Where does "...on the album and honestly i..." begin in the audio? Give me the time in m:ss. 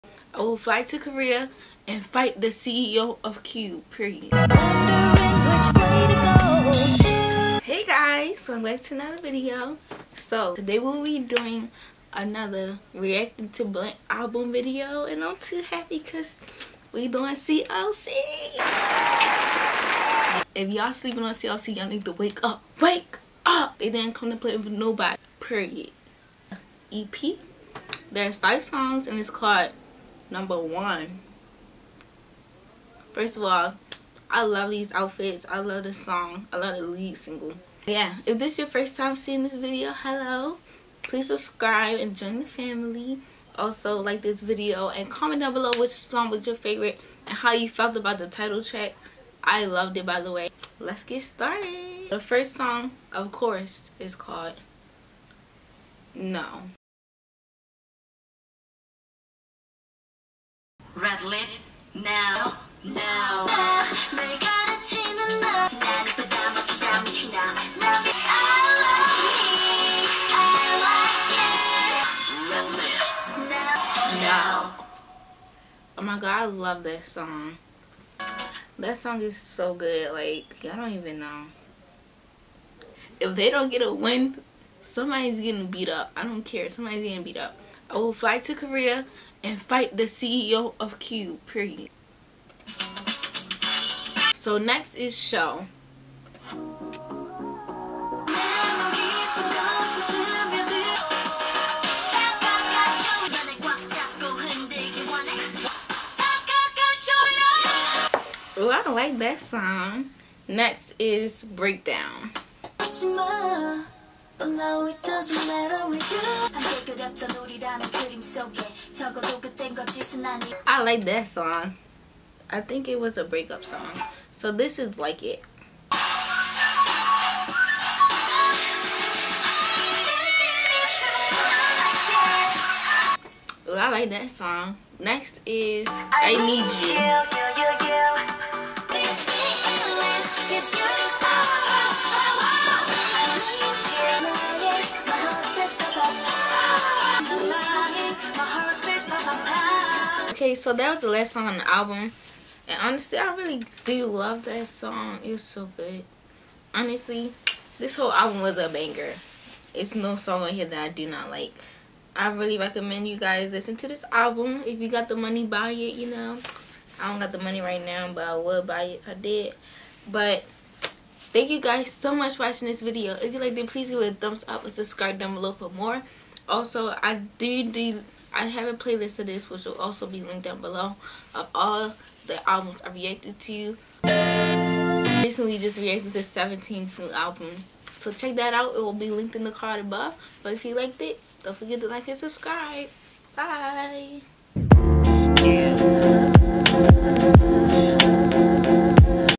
2:31.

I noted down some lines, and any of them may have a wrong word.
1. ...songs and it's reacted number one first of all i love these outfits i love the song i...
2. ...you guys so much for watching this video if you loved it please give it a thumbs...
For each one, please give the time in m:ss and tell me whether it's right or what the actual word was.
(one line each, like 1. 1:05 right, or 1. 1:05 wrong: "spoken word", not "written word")
1. 0:28 wrong: "called", not "reacted"
2. 2:51 wrong: "liked", not "loved".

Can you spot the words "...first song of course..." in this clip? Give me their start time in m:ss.
0:52.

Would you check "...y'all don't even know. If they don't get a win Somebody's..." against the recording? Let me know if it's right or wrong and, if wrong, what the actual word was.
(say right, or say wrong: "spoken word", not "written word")
right.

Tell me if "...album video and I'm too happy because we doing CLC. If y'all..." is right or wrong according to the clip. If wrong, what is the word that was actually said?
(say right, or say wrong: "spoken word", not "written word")
right.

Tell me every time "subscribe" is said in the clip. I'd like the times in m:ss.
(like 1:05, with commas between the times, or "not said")
0:41, 2:54, 3:12.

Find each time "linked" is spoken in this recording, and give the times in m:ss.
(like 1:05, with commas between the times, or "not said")
3:00, 3:09.